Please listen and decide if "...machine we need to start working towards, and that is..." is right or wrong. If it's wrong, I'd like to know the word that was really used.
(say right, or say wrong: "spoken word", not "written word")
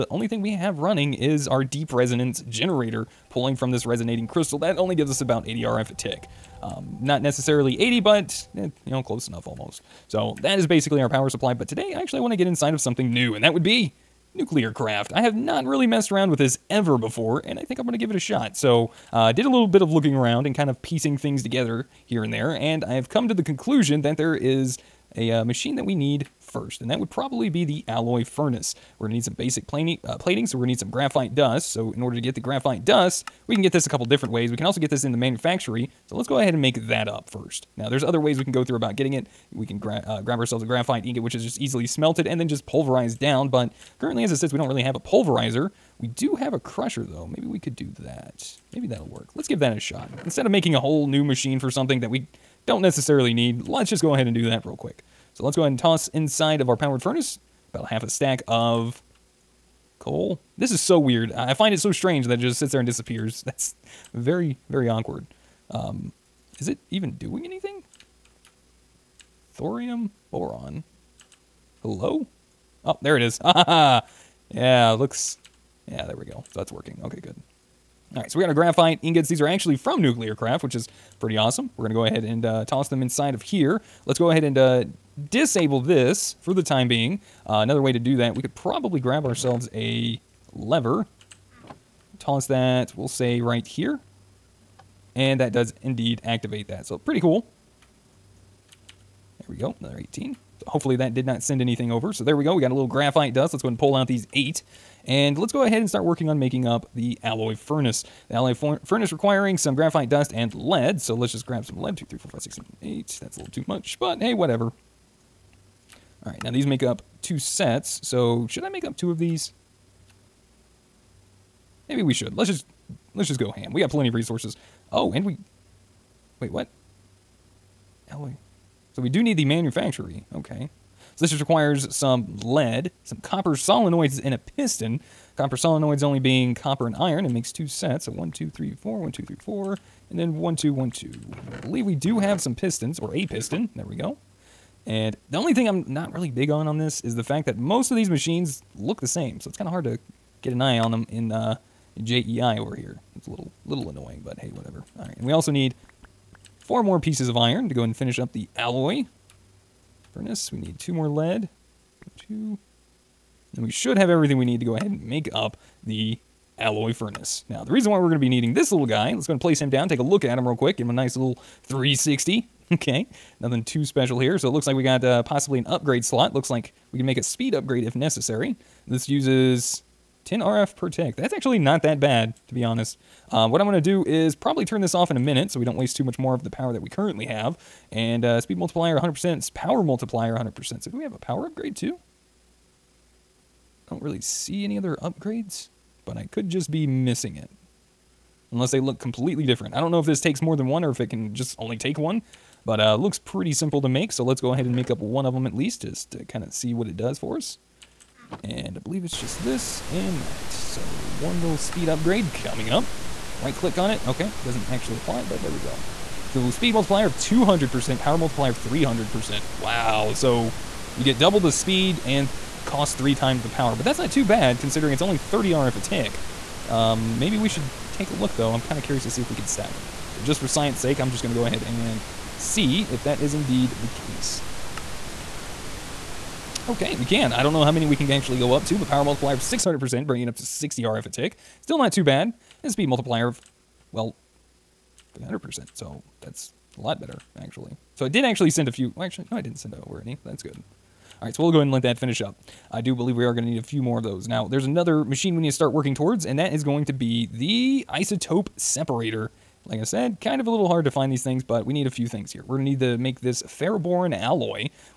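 right.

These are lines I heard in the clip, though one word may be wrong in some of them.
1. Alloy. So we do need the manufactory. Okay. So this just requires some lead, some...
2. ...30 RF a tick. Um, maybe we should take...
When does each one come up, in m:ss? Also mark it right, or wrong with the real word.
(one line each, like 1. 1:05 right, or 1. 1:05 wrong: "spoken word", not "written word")
1. 2:08 right
2. 3:45 right.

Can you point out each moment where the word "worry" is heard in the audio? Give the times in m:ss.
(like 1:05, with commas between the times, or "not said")
not said.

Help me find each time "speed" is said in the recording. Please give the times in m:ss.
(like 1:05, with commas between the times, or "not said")
2:57, 3:08, 3:31, 3:36, 3:41, 4:02.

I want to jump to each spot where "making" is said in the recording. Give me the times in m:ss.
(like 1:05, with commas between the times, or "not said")
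0:50, 1:46.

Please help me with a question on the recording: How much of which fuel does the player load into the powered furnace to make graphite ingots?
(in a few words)
half a stack of coal.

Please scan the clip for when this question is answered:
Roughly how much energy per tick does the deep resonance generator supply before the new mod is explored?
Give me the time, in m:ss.
0:05.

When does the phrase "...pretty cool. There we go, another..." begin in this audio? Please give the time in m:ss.
1:36.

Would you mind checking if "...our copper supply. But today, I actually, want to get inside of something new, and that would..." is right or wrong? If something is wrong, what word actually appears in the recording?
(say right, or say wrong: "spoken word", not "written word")
wrong: "power", not "copper".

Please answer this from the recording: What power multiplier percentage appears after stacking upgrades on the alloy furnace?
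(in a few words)
600%.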